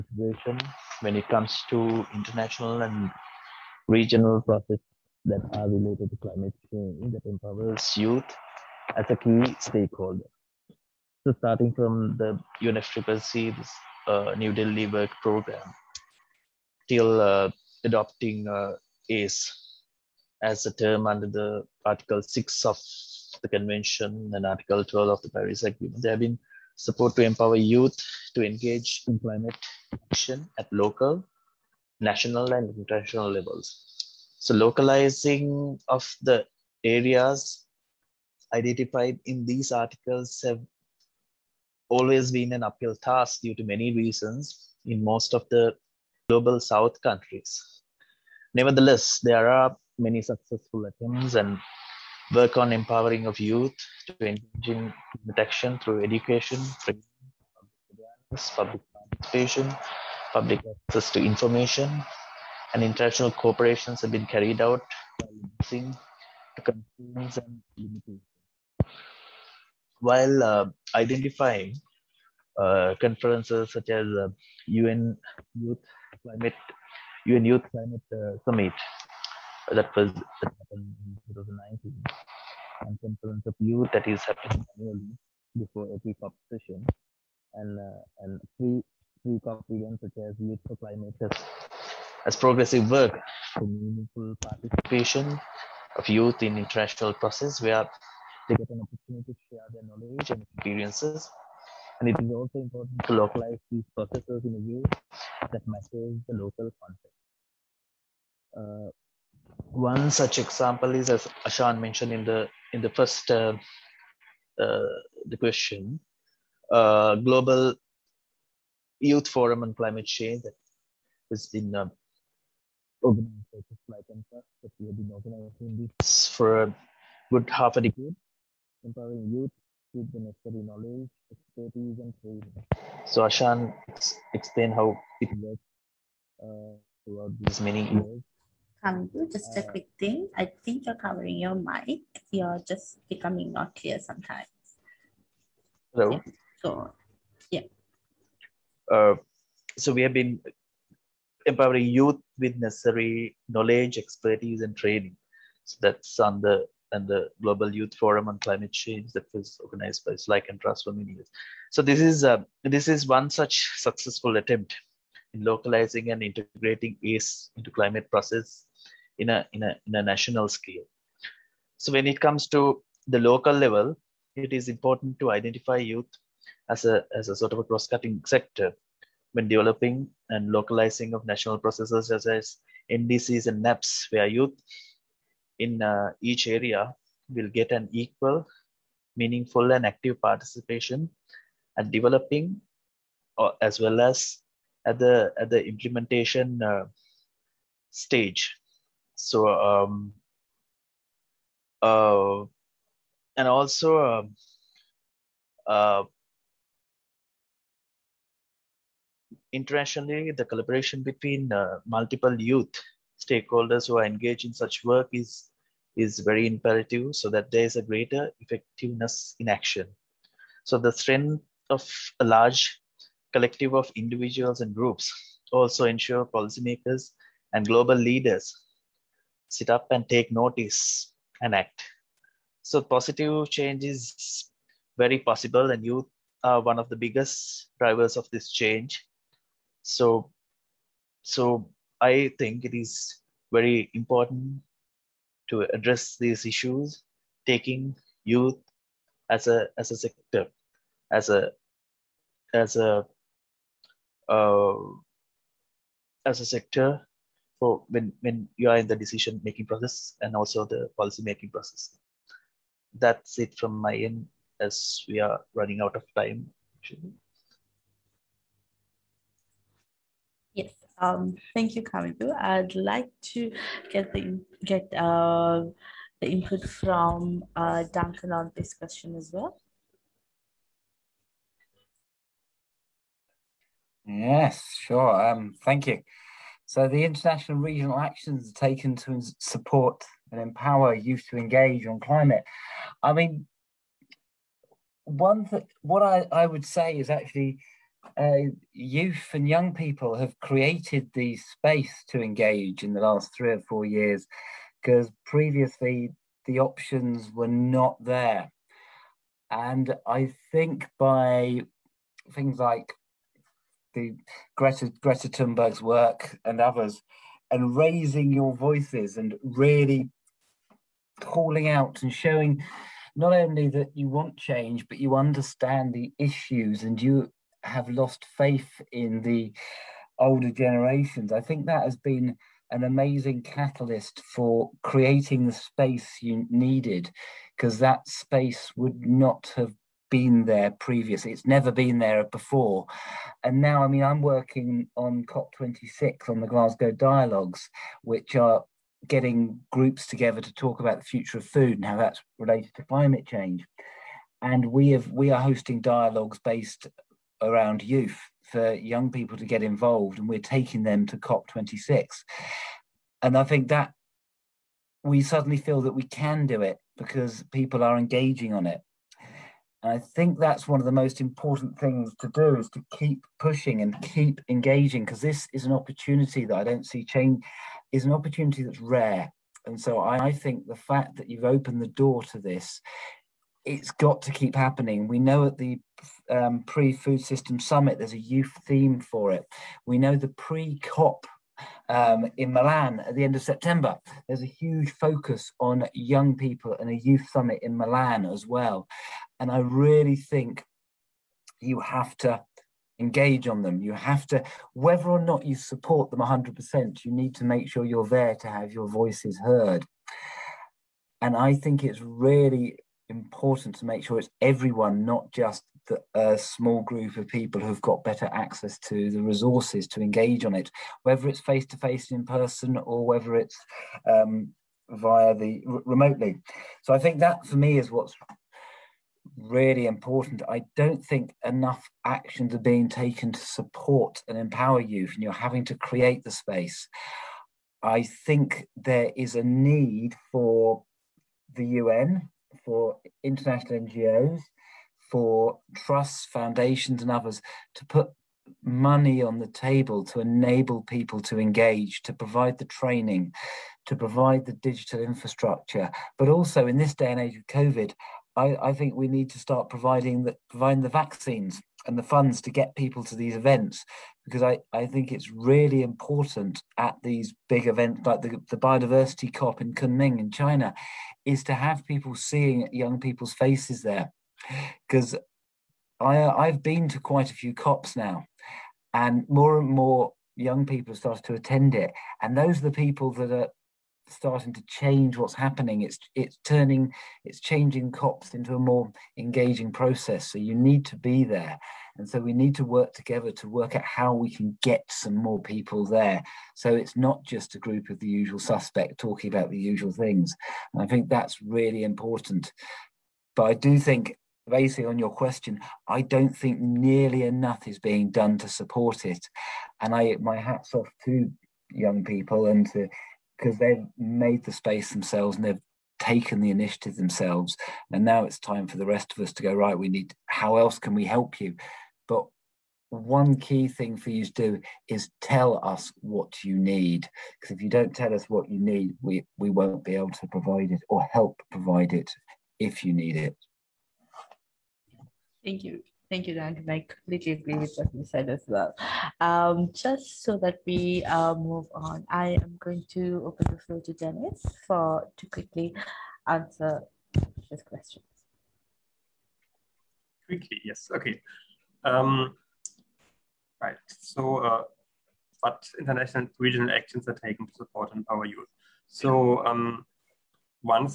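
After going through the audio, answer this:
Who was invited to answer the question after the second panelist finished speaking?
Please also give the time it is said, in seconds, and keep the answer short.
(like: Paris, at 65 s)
Dennis, at 543 s.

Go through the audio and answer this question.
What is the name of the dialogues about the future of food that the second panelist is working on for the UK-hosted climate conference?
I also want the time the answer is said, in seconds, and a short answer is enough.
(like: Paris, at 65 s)
Glasgow dialogues, at 346 s.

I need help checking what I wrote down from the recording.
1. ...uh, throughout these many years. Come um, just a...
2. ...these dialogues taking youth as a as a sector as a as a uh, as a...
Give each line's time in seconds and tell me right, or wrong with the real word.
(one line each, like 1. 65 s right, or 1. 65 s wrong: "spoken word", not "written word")
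1. 136 s right
2. 246 s wrong: "issues", not "dialogues".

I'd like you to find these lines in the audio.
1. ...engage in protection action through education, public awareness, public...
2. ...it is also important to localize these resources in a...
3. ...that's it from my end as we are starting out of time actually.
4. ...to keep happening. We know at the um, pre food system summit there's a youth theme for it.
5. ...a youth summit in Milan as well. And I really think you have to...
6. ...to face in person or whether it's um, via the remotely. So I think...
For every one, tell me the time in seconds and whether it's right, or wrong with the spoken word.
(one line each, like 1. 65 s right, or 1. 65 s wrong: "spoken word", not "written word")
1. 54 s right
2. 102 s wrong: "processes", not "resources"
3. 262 s wrong: "running", not "starting"
4. 384 s right
5. 396 s right
6. 421 s right.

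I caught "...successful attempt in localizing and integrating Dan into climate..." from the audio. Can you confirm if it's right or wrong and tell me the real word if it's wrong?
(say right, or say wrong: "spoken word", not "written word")
wrong: "ACE", not "Dan".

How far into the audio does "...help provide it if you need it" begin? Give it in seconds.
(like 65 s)
531 s.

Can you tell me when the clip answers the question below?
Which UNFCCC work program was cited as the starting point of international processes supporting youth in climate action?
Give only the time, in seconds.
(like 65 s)
14 s.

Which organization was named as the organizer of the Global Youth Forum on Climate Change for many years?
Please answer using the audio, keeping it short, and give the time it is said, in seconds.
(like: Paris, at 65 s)
SLYCAN Trust, at 160 s.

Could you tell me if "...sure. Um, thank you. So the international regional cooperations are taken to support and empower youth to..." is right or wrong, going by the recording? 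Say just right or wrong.
wrong.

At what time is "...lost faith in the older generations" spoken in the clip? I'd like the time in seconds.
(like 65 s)
327 s.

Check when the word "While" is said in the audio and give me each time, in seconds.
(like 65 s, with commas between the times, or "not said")
70 s.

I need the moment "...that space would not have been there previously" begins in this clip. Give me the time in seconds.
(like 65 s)
337 s.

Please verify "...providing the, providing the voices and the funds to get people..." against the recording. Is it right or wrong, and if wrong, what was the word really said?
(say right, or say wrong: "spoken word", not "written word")
wrong: "vaccines", not "voices".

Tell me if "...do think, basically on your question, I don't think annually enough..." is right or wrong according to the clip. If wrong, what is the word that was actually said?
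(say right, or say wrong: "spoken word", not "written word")
wrong: "nearly", not "annually".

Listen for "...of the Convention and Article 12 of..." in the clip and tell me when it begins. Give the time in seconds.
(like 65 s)
22 s.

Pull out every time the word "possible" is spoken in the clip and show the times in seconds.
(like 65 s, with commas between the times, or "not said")
235 s.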